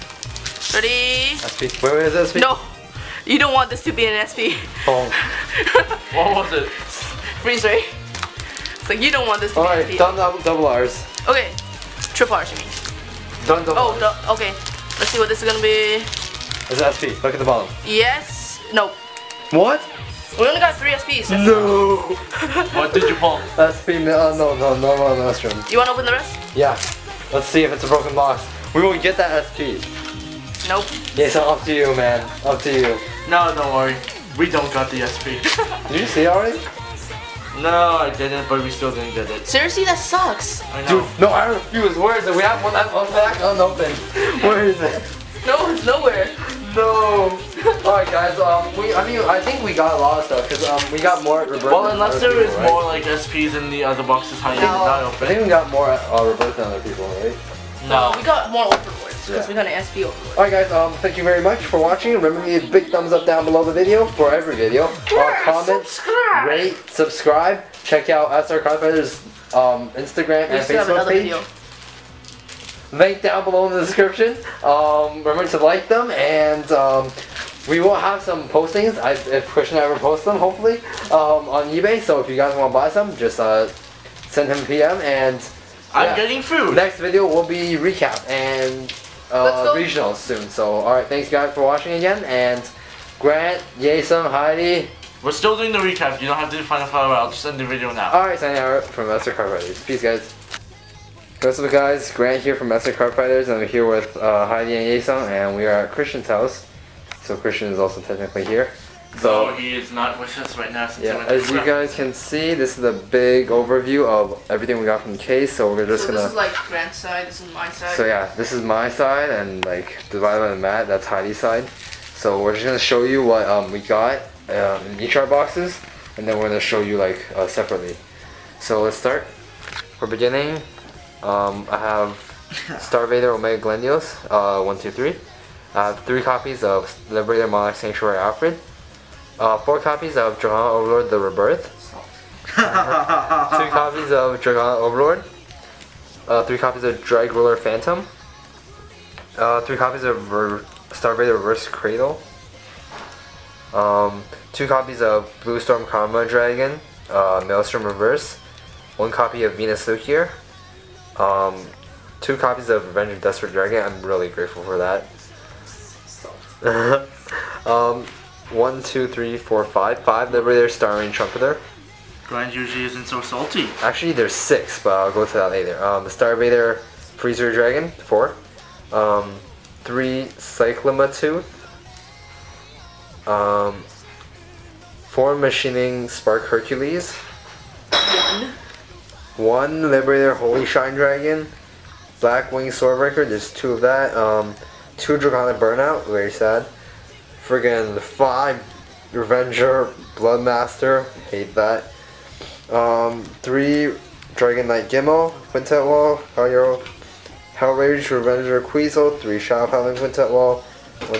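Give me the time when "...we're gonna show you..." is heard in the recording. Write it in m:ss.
2:06.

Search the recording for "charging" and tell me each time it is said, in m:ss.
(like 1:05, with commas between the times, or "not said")
not said.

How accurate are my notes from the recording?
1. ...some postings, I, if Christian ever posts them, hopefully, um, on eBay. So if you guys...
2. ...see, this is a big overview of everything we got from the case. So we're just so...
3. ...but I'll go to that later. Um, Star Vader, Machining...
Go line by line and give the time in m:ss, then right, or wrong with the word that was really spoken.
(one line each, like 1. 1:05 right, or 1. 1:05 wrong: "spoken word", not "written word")
1. 1:18 right
2. 1:52 right
3. 2:54 wrong: "Freezer", not "Machining".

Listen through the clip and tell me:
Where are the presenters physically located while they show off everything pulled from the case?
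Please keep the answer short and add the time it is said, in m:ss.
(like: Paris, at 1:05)
Christian's house, at 1:45.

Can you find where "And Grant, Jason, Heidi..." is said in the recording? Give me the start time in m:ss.
1:32.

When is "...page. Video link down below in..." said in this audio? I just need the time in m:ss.
1:11.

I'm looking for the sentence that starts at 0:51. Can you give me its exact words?
Well, unless there is people, more right?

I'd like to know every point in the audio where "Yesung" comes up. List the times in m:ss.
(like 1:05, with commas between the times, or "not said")
1:44.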